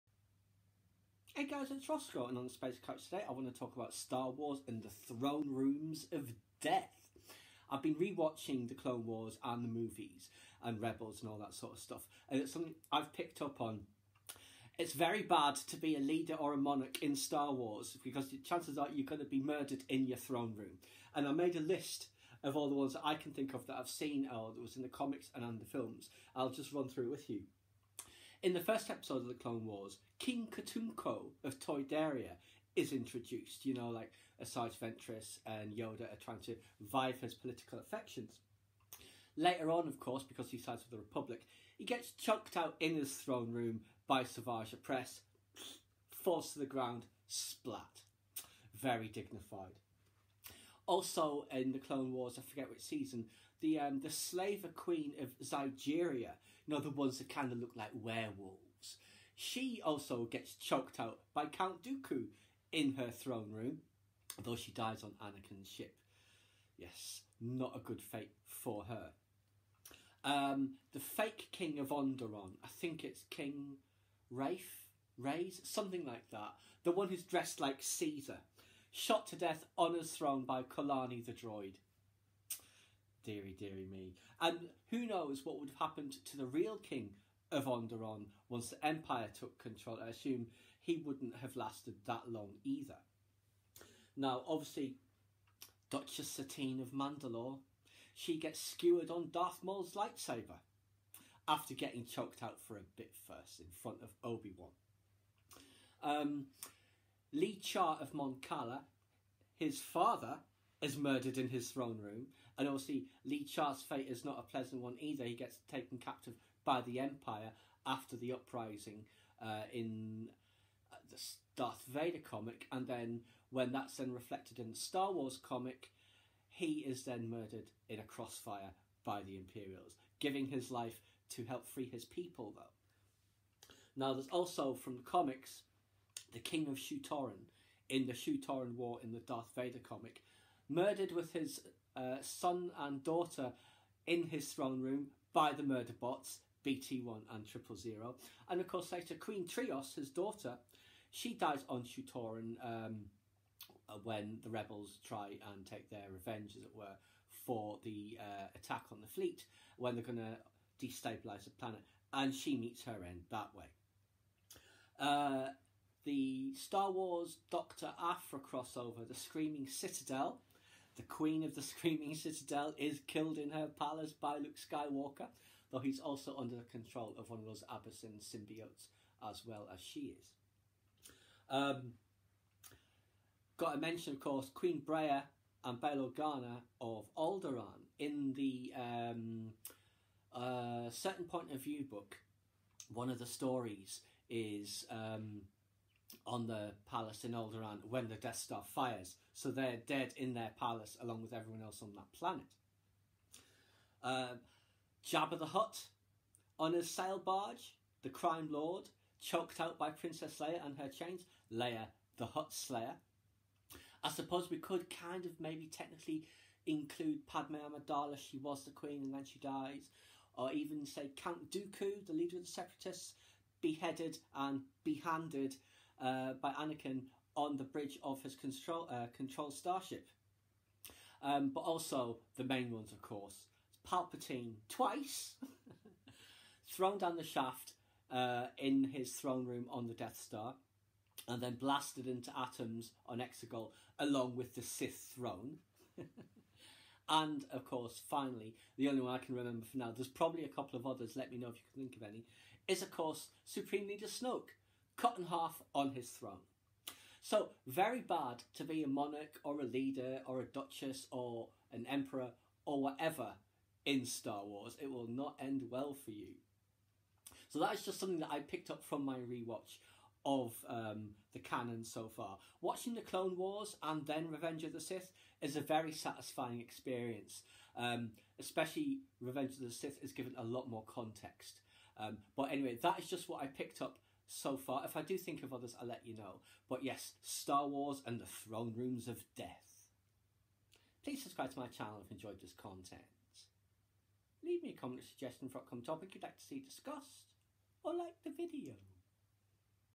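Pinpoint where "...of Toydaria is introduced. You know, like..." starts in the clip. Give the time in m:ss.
0:31.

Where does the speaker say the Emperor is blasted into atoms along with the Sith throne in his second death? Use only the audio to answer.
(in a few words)
Exegol.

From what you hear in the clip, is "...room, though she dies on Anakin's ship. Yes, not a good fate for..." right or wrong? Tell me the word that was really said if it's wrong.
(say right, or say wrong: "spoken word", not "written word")
right.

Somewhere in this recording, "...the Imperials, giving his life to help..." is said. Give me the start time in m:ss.
2:09.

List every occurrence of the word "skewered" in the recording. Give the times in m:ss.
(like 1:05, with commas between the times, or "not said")
1:38.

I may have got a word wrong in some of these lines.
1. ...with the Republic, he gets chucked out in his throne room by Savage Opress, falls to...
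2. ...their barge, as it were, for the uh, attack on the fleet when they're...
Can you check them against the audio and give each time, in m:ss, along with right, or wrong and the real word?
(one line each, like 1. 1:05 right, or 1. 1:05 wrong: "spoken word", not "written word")
1. 0:40 right
2. 2:35 wrong: "revenge", not "barge".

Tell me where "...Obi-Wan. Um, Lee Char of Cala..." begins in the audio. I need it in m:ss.
1:44.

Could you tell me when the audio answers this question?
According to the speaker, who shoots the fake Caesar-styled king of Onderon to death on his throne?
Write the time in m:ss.
1:20.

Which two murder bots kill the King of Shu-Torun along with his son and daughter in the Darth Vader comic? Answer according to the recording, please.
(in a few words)
BT1 and Triple Zero.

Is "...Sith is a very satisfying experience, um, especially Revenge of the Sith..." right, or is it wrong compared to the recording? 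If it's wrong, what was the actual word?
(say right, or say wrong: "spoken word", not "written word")
right.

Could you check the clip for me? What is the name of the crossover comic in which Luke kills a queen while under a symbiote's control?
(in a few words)
The Screaming Citadel.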